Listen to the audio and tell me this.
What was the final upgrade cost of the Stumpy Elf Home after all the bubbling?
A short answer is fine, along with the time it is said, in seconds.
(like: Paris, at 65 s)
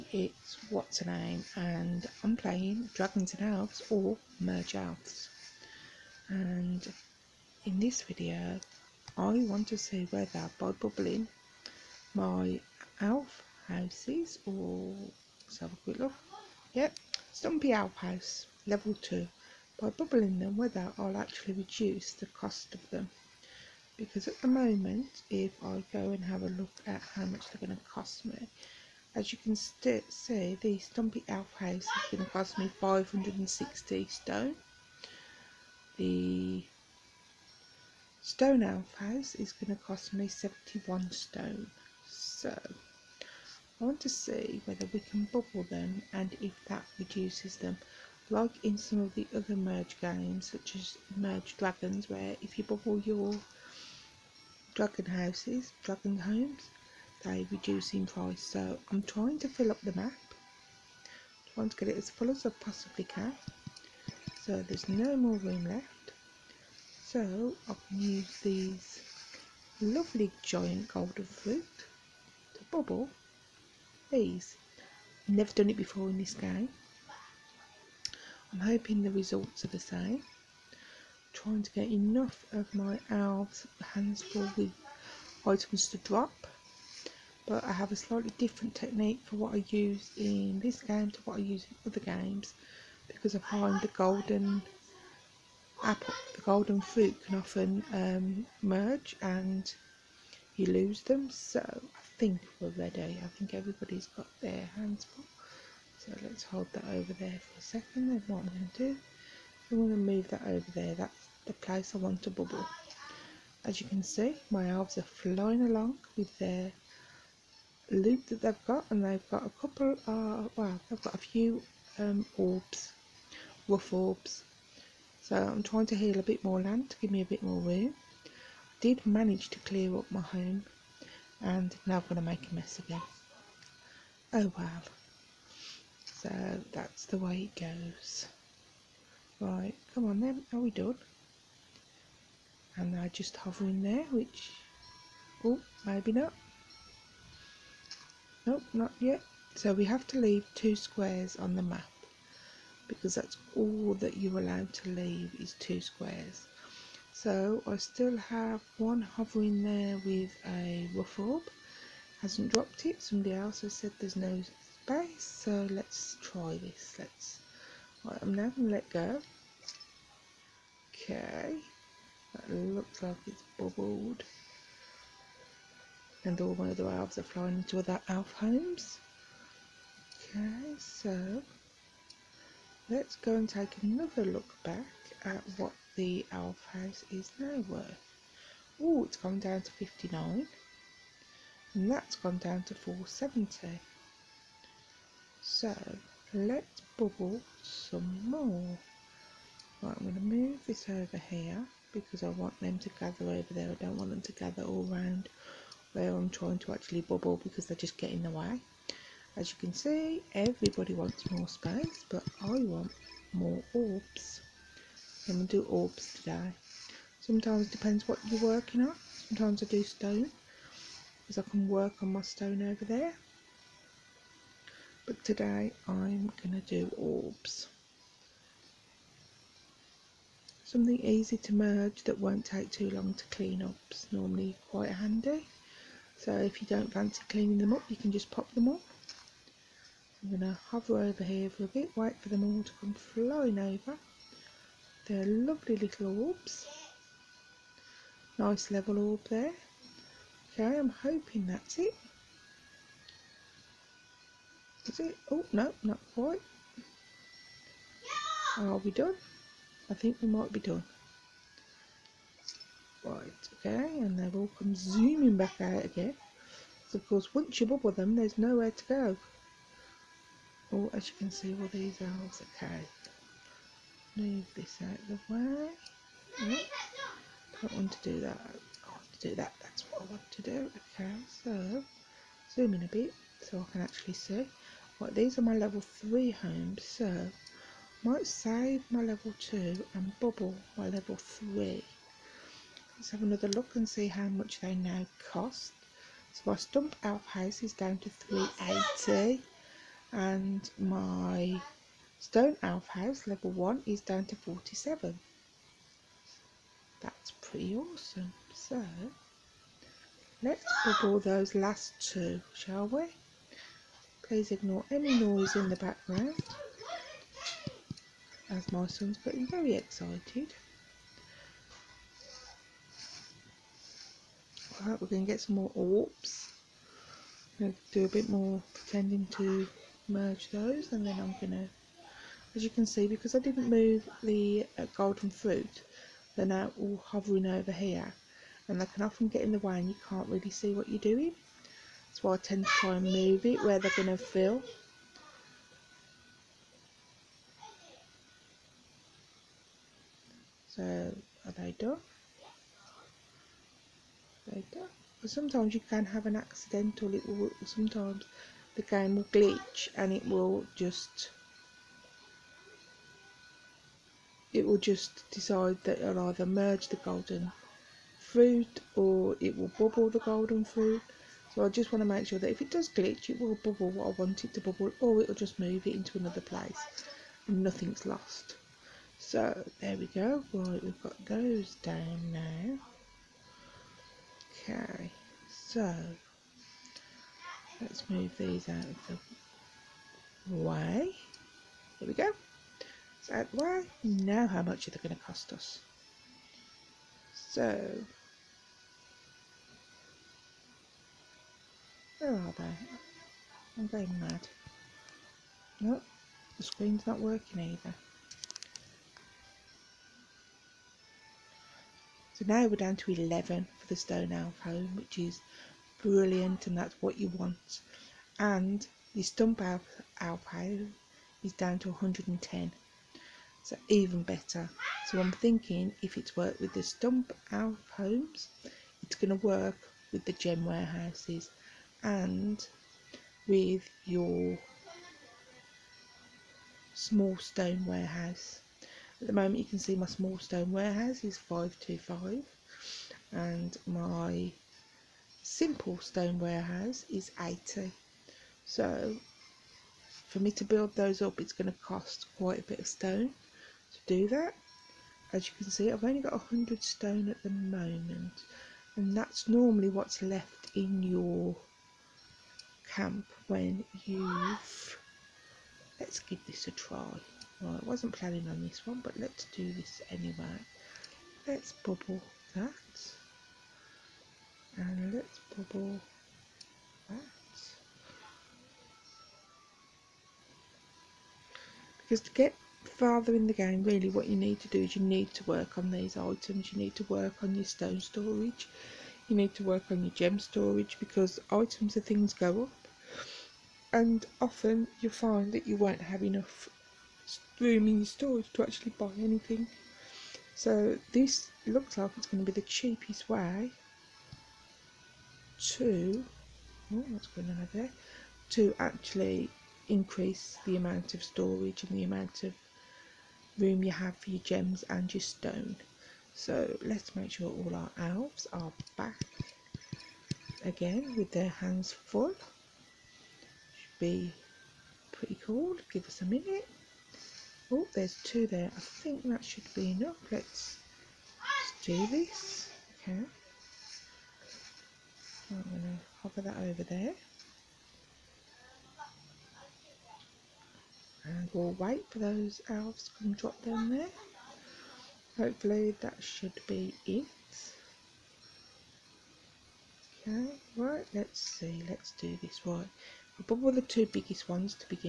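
110, at 421 s.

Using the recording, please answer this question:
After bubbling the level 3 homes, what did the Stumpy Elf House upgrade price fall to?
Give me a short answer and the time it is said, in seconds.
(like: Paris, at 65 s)
380, at 298 s.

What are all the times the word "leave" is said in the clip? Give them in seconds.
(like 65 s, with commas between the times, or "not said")
150 s, 154 s.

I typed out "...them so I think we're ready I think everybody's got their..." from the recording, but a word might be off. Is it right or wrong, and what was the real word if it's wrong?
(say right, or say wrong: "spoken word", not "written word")
right.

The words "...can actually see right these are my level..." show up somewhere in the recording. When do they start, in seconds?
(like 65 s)
283 s.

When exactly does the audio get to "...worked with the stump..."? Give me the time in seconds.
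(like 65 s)
426 s.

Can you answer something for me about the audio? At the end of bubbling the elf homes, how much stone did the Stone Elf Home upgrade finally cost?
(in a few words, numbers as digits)
11.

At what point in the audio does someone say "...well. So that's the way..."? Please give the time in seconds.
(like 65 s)
134 s.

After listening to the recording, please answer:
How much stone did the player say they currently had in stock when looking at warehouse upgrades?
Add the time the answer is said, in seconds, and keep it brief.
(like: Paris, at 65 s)
100 stone, at 456 s.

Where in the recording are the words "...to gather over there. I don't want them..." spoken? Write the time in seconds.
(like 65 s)
202 s.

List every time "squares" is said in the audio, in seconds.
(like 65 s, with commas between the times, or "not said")
150 s, 155 s.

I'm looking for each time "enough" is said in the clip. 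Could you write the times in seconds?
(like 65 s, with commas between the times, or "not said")
81 s, 496 s, 529 s.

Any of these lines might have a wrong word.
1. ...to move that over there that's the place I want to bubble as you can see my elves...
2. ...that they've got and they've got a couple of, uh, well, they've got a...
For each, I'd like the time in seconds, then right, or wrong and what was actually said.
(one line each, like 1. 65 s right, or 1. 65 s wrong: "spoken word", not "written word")
1. 109 s right
2. 118 s right.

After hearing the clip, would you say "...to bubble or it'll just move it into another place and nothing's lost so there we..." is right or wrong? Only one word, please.
right.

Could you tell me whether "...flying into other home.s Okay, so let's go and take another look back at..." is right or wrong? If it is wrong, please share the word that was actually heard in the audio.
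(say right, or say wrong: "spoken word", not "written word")
right.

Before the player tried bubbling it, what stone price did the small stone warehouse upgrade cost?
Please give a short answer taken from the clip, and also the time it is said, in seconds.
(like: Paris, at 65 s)
525, at 441 s.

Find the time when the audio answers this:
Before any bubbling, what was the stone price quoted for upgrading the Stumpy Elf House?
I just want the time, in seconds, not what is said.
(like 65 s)
32 s.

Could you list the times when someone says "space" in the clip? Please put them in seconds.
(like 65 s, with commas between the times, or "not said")
164 s, 211 s.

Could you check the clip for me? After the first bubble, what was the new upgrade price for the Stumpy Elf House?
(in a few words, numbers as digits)
470.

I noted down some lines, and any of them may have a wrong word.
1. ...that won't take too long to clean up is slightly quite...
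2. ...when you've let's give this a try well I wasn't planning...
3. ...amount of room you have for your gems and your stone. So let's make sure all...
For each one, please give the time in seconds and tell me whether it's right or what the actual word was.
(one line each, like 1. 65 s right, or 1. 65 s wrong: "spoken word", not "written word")
1. 232 s wrong: "normally", not "slightly"
2. 463 s right
3. 512 s right.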